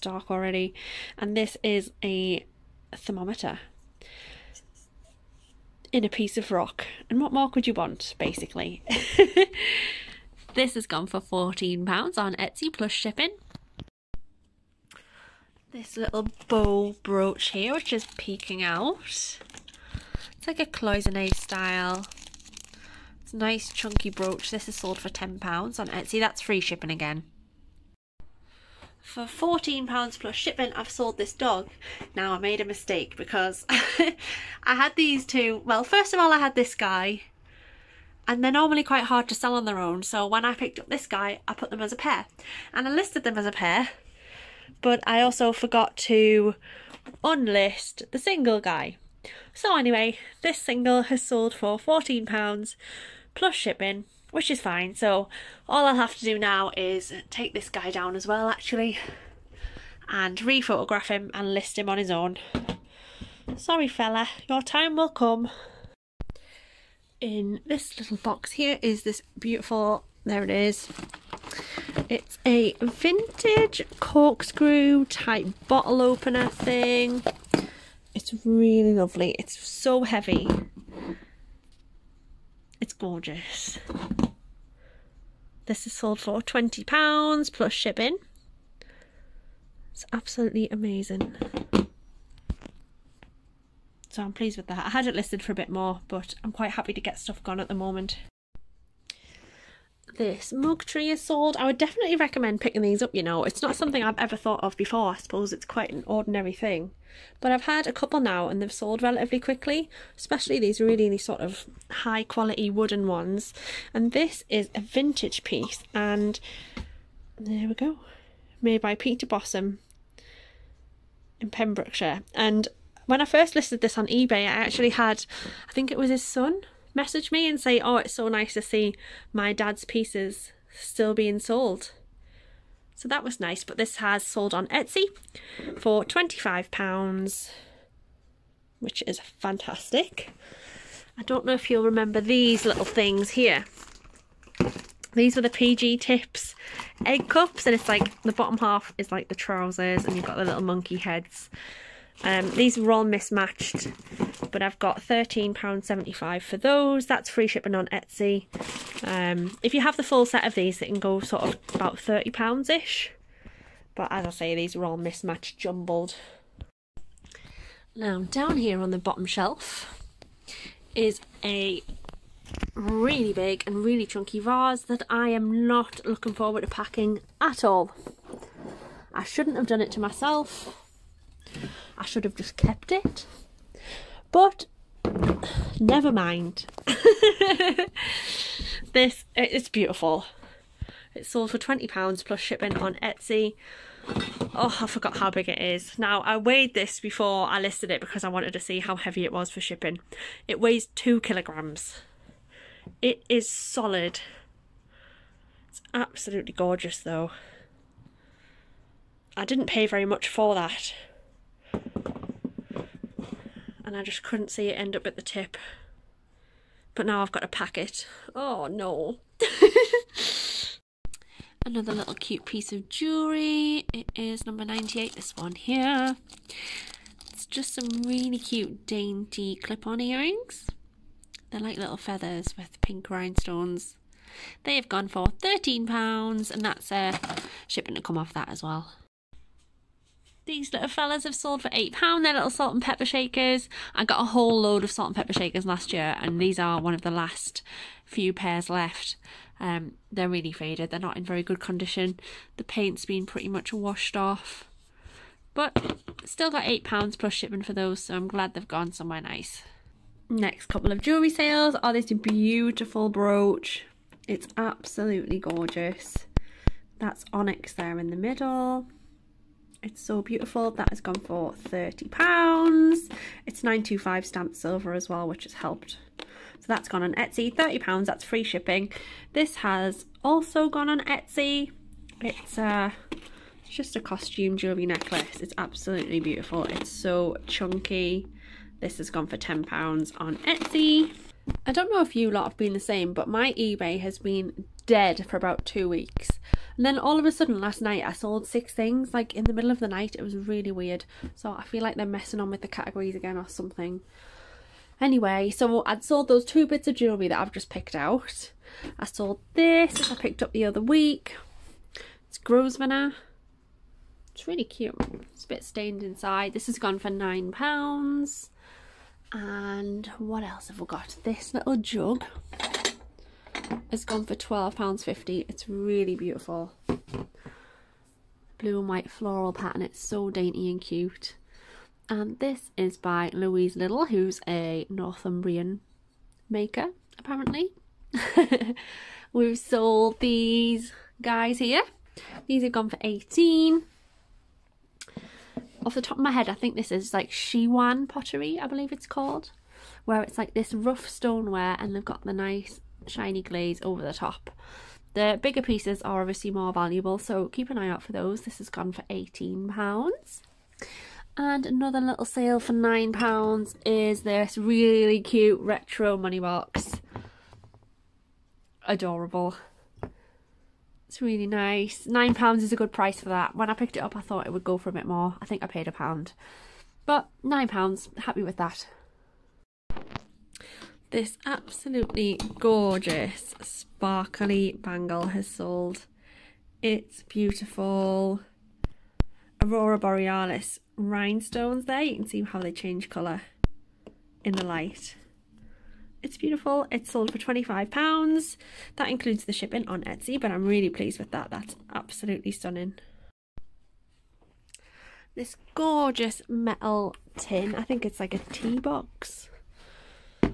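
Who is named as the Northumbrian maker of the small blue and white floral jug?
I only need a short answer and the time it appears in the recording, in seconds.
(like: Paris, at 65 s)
Louise Little, at 333 s.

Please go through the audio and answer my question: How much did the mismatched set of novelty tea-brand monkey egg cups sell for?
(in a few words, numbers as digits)
£13.75.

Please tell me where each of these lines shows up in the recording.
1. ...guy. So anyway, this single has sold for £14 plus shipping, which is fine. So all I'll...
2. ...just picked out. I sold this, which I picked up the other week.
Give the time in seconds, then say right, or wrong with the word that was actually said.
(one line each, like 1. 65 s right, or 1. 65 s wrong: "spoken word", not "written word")
1. 48 s right
2. 307 s right.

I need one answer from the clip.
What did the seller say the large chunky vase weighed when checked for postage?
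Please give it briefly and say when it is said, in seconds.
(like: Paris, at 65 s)
2 kilograms, at 200 s.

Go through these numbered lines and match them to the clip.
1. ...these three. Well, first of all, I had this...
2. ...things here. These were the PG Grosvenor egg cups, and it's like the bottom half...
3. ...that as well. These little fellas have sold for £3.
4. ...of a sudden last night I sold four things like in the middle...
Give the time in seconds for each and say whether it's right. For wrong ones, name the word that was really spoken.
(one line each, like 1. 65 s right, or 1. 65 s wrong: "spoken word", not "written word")
1. 34 s wrong: "two", not "three"
2. 142 s wrong: "Tips", not "Grosvenor"
3. 238 s wrong: "8", not "3"
4. 297 s wrong: "six", not "four".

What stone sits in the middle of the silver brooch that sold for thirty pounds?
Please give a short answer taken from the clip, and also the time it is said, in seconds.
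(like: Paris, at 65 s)
Onyx, at 267 s.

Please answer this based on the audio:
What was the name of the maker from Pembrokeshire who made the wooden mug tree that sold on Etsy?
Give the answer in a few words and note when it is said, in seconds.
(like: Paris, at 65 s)
Peter Bossom, at 118 s.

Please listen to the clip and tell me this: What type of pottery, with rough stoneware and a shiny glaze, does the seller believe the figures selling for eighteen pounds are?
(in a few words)
Shiwan pottery.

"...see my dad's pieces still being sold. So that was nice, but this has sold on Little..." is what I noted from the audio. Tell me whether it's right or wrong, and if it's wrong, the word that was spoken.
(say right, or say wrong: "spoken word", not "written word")
wrong: "Etsy", not "Little".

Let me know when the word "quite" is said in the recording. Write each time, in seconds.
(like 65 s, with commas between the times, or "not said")
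38 s, 96 s, 105 s.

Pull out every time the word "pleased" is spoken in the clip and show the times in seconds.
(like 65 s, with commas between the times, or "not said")
94 s, 400 s.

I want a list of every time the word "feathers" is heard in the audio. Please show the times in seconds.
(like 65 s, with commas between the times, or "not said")
231 s.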